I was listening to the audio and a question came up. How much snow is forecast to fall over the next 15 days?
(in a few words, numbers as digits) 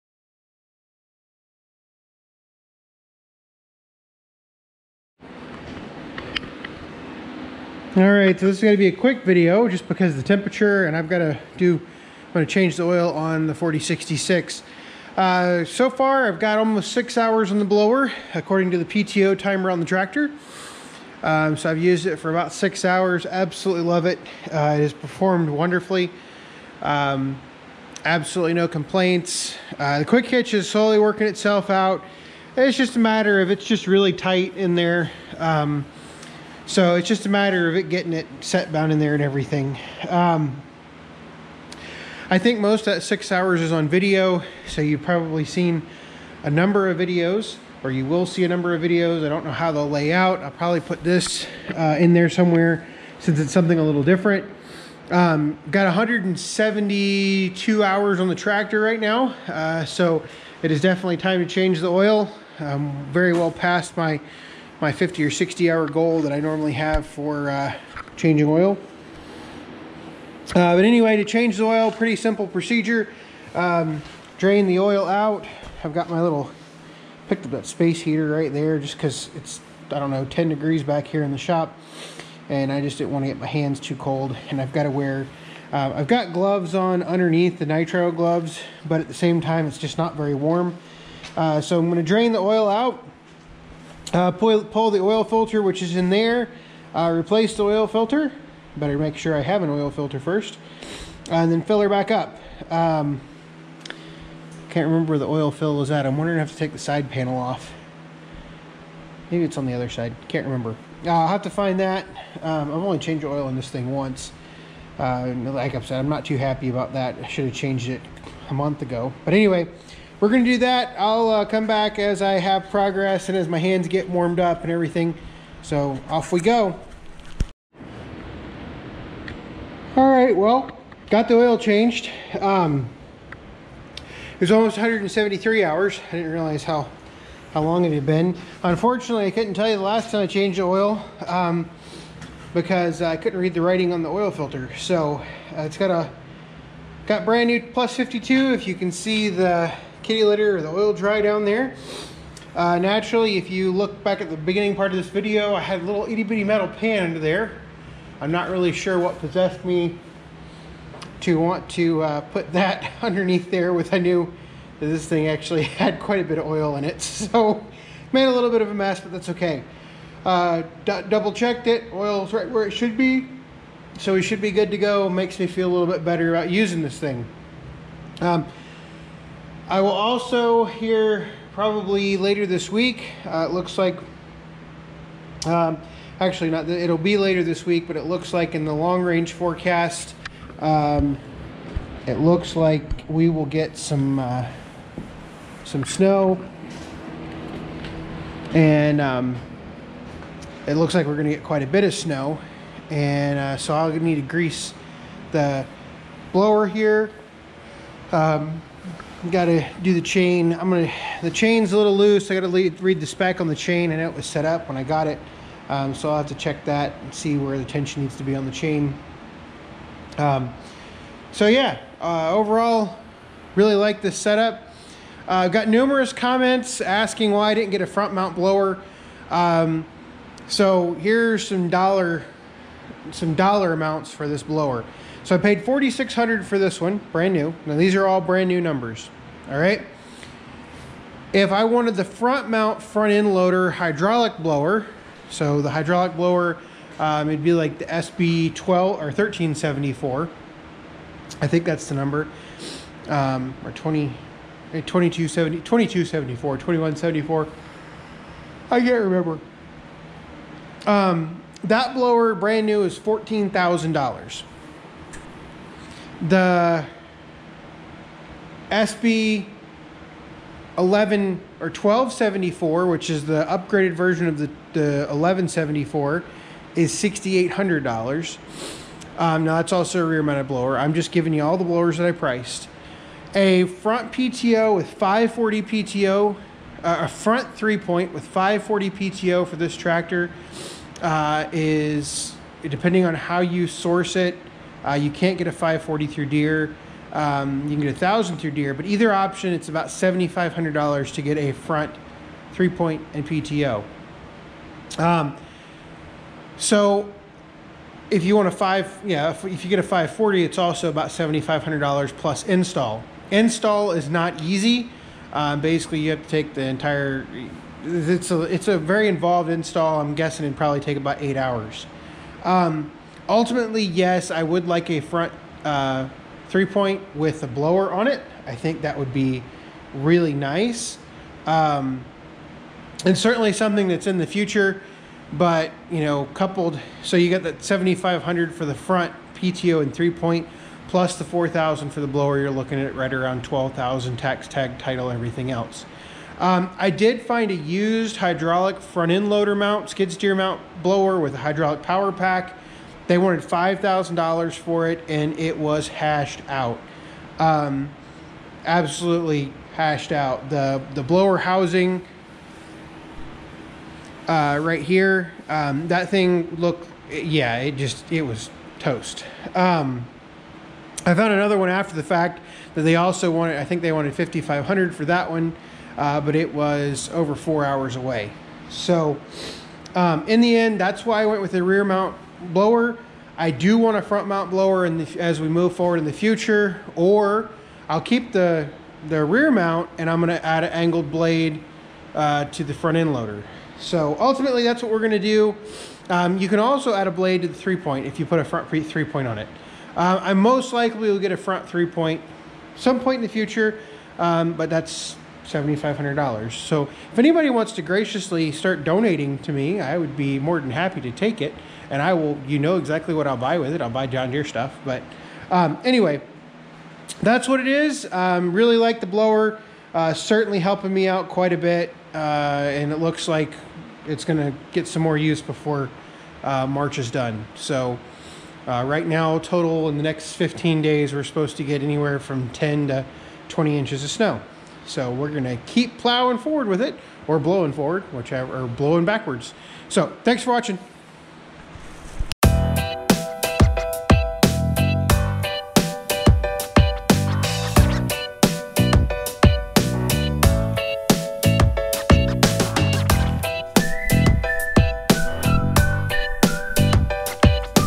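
10 to 20 inches.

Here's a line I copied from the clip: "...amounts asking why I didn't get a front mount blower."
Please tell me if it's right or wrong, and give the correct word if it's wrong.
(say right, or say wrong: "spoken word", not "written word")
wrong: "comments", not "amounts".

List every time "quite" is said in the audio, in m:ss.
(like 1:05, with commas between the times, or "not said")
2:45, 3:21, 7:01.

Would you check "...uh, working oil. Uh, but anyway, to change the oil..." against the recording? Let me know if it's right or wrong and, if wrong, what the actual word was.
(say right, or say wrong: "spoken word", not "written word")
wrong: "changing", not "working".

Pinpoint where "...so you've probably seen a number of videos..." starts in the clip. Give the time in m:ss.
0:44.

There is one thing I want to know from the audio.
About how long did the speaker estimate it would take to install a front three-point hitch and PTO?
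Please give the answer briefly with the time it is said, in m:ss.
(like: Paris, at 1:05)
about 8 hours, at 5:20.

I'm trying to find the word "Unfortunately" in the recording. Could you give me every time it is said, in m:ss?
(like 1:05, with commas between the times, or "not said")
2:18.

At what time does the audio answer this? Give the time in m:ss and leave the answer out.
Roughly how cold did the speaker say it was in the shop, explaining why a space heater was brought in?
1:20.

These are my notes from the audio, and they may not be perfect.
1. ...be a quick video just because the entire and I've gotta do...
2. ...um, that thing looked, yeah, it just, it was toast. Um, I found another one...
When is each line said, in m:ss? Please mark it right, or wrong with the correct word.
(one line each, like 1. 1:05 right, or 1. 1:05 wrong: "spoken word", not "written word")
1. 0:08 wrong: "temperature", not "entire"
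2. 6:05 right.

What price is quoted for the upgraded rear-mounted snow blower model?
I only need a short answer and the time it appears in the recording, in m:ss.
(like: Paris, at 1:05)
$6,800, at 4:36.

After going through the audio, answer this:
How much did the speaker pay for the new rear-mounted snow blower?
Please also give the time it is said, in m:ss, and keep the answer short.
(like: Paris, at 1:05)
$4,600, at 3:55.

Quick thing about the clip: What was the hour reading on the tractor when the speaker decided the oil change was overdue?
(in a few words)
172 hours.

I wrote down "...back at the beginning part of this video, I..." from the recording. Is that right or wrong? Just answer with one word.
right.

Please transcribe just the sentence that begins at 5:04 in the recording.
Um, so if you want a five, yeah, if, if you get a 540, it's also about $7,500 plus install.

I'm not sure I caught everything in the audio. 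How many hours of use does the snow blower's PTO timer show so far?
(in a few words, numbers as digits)
almost 6 hours.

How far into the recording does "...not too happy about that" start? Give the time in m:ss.
1:56.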